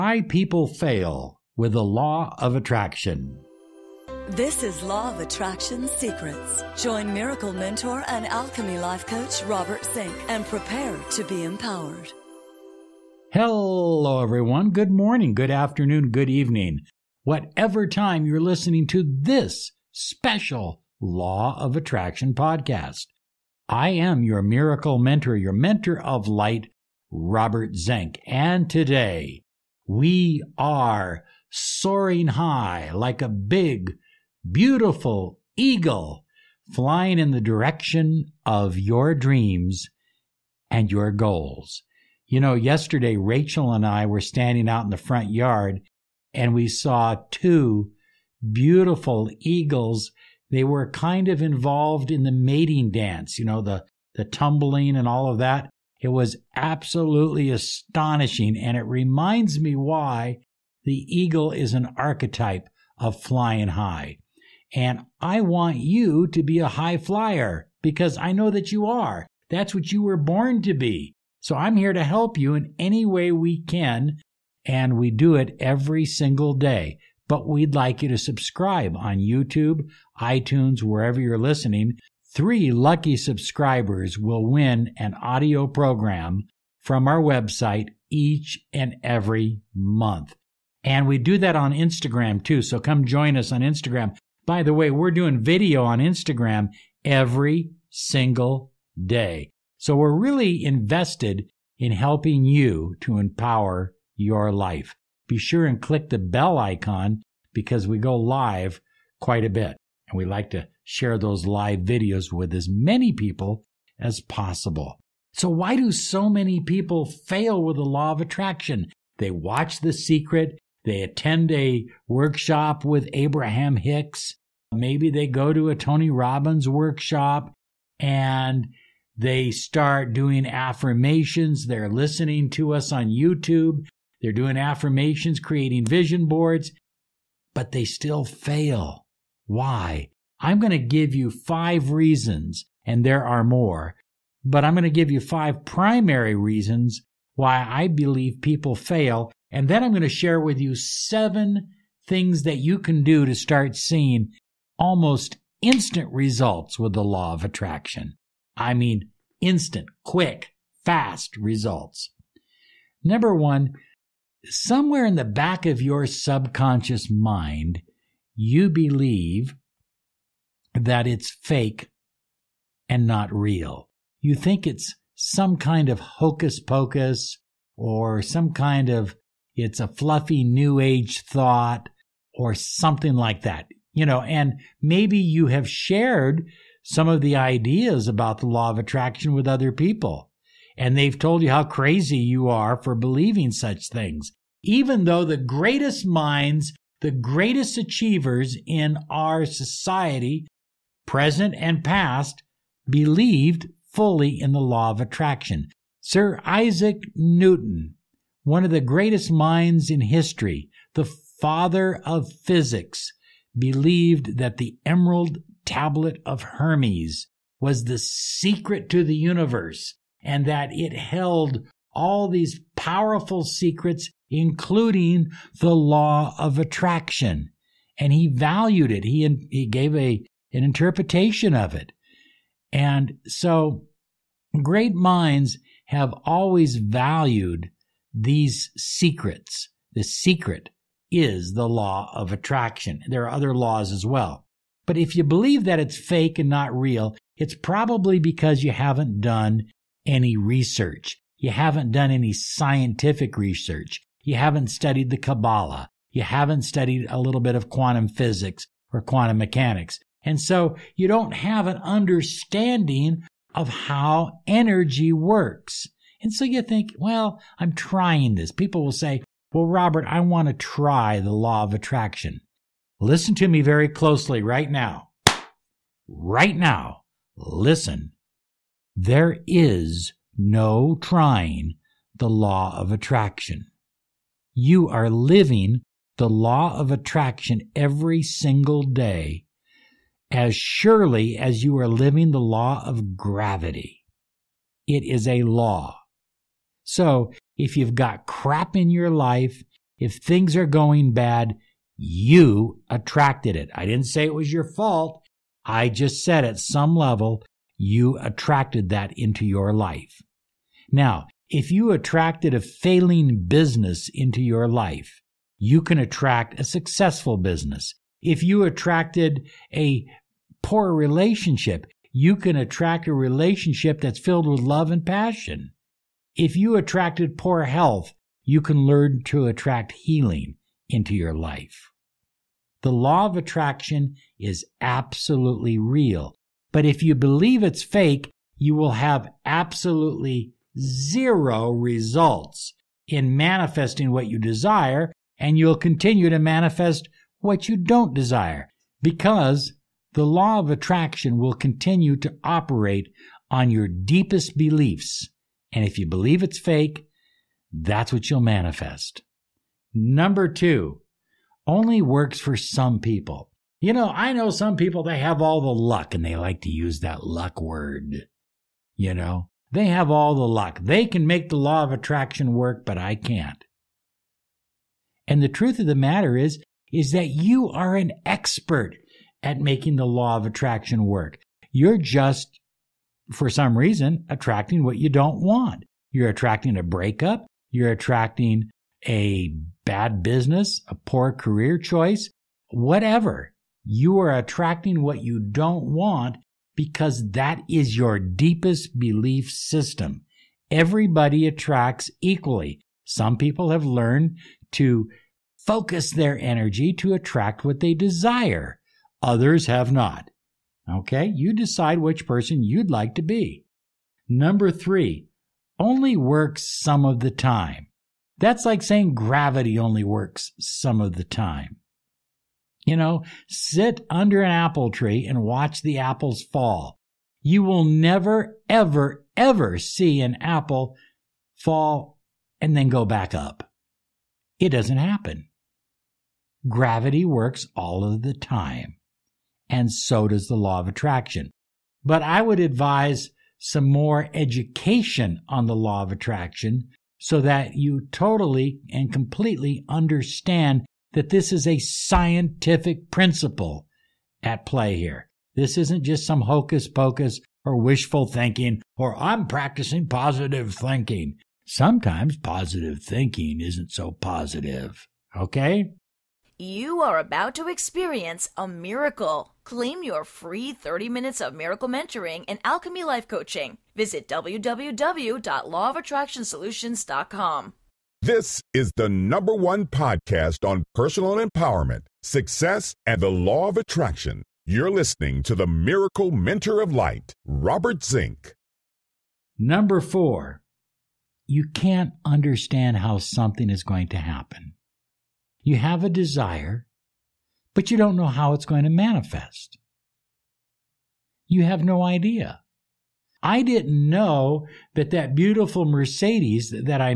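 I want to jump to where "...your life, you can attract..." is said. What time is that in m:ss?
5:14.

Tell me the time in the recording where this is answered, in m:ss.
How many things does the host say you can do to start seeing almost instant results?
2:30.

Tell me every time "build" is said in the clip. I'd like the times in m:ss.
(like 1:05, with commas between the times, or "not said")
not said.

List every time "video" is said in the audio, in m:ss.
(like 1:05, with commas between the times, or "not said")
1:35, 1:51.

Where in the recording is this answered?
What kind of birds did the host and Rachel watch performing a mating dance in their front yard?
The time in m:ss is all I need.
0:49.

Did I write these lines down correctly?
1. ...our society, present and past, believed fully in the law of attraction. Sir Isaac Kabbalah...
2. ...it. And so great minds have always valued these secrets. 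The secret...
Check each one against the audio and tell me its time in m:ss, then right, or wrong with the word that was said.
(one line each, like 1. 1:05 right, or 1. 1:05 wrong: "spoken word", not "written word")
1. 3:19 wrong: "Newton", not "Kabbalah"
2. 3:51 right.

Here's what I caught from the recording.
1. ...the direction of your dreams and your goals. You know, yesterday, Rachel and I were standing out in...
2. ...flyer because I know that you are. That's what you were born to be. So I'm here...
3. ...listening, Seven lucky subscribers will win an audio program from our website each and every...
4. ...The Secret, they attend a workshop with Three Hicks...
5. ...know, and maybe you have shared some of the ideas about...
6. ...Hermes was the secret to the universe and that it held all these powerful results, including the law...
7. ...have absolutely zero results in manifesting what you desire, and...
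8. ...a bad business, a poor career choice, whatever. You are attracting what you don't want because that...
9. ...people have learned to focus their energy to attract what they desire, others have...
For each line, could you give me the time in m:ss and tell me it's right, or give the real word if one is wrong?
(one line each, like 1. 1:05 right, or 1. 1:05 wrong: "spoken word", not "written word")
1. 0:37 right
2. 1:06 right
3. 1:21 wrong: "Three", not "Seven"
4. 1:59 wrong: "Abraham", not "Three"
5. 3:04 right
6. 3:36 wrong: "secrets", not "results"
7. 5:38 right
8. 6:29 right
9. 6:43 right.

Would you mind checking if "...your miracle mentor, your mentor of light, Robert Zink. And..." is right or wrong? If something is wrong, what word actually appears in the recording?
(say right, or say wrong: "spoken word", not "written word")
right.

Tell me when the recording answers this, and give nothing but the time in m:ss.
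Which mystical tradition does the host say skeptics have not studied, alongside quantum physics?
4:15.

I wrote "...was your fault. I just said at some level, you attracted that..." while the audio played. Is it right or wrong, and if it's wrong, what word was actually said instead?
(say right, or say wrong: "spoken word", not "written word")
right.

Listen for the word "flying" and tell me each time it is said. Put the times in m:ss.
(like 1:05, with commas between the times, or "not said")
0:36, 1:03.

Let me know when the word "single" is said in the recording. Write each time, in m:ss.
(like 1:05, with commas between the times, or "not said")
1:16, 1:37, 4:48.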